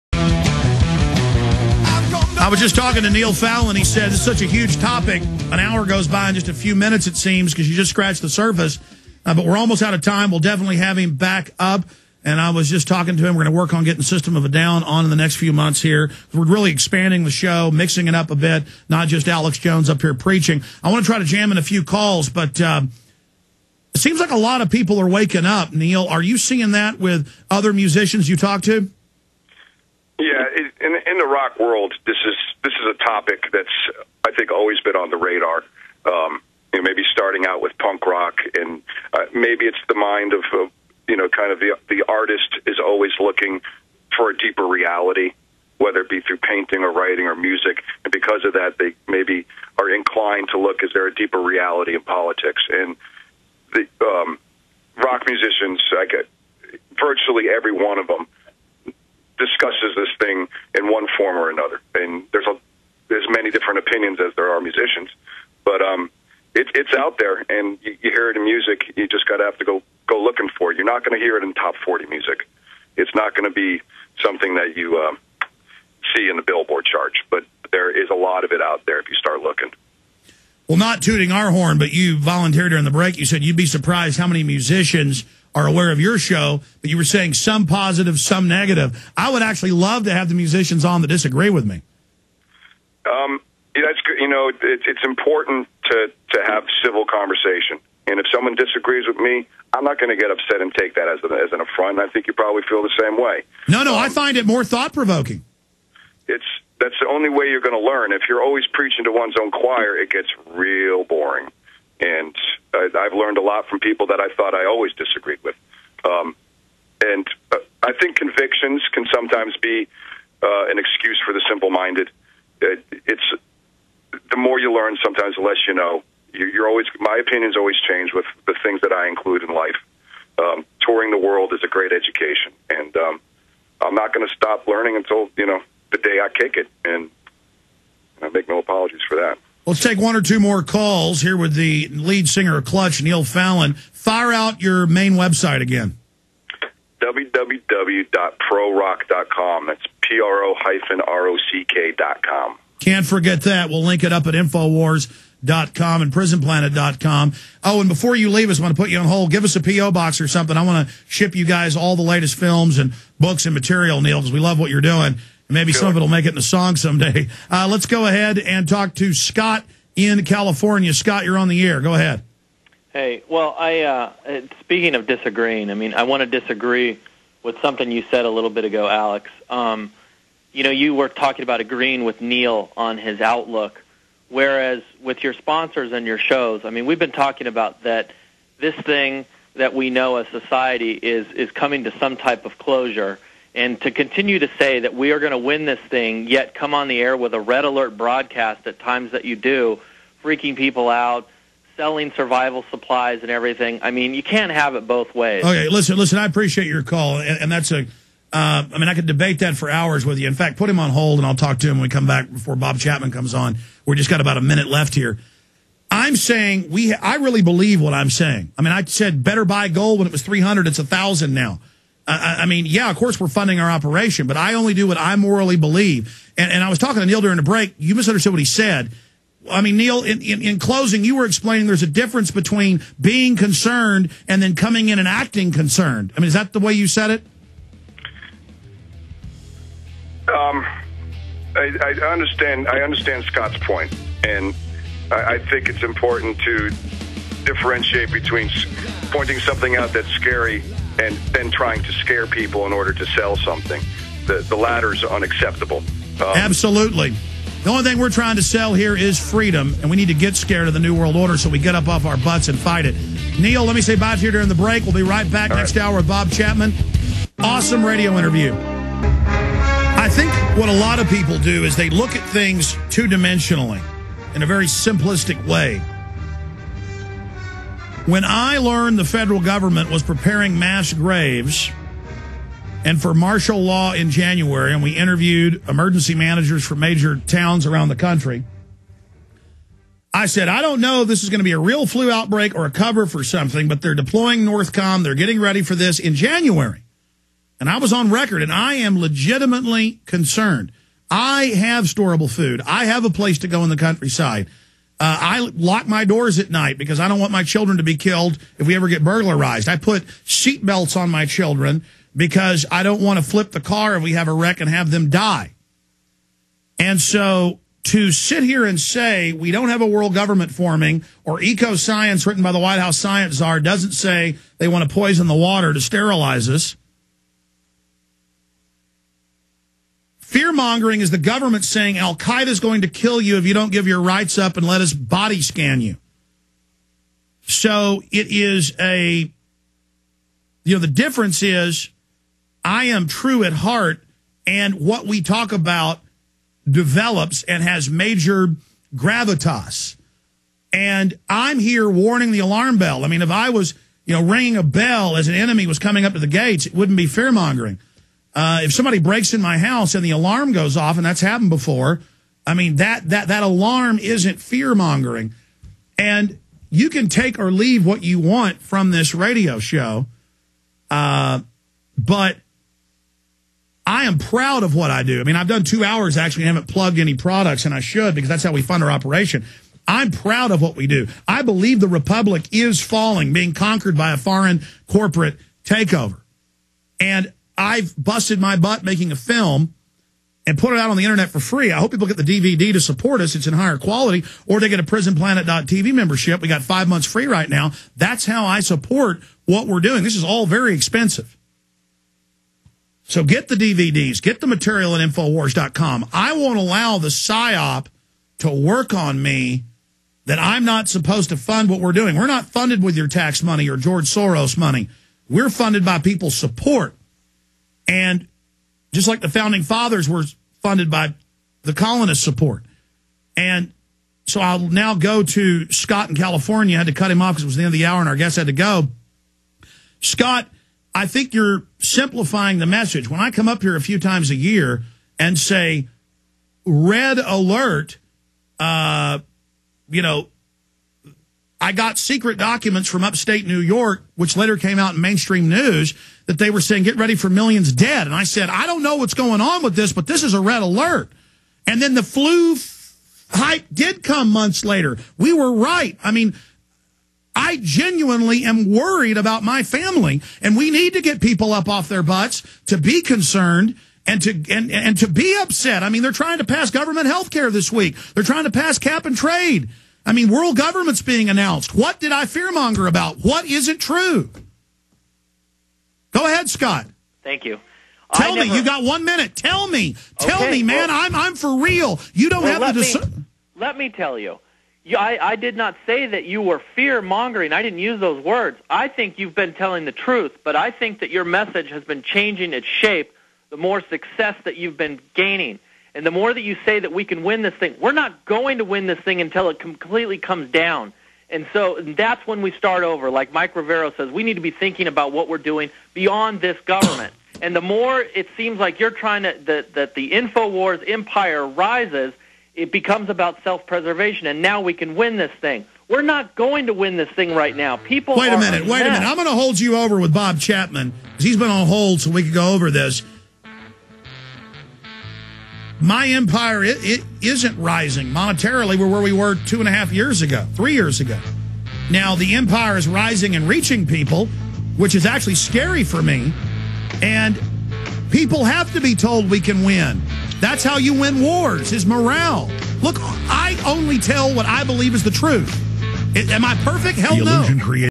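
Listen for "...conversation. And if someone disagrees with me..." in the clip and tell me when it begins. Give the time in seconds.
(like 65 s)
97 s.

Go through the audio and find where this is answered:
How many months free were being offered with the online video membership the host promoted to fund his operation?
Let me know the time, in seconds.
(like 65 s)
396 s.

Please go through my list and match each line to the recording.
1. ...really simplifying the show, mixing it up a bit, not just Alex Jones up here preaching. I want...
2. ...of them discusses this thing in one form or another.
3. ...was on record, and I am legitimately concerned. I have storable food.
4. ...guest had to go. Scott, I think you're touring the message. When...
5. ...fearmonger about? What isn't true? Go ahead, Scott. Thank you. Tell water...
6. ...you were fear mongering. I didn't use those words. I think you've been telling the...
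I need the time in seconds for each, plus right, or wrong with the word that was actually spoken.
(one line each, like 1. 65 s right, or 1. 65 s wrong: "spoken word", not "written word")
1. 16 s wrong: "expanding", not "simplifying"
2. 57 s right
3. 297 s right
4. 428 s wrong: "simplifying", not "touring"
5. 472 s wrong: "never", not "water"
6. 486 s right.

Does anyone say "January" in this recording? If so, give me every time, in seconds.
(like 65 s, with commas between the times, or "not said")
284 s, 296 s.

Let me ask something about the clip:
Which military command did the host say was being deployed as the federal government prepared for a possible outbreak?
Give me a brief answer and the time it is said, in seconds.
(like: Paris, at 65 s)
Northcom, at 294 s.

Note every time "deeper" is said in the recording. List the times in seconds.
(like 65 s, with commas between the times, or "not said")
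44 s, 51 s.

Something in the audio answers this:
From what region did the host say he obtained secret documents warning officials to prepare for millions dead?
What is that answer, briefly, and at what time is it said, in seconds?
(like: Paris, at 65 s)
upstate New York, at 443 s.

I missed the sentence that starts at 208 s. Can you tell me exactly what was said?
Uh, I mean, I could debate that for hours with you.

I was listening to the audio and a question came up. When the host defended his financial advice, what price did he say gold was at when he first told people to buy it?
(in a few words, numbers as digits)
300.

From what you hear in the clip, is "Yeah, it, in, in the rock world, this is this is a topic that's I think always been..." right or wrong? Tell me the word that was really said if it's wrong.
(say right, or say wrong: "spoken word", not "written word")
right.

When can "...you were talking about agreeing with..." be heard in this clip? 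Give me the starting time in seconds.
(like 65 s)
180 s.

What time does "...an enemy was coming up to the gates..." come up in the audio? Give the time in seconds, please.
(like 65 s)
355 s.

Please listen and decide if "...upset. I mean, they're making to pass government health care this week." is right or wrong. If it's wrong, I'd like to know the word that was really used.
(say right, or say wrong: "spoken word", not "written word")
wrong: "trying", not "making".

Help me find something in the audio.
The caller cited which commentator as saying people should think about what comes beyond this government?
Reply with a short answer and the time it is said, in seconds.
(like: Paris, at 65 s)
Mike Rivero, at 503 s.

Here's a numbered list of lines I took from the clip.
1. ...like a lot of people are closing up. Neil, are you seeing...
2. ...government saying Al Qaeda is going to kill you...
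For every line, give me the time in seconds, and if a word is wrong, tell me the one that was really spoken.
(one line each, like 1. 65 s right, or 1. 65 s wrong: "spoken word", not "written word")
1. 24 s wrong: "waking", not "closing"
2. 331 s right.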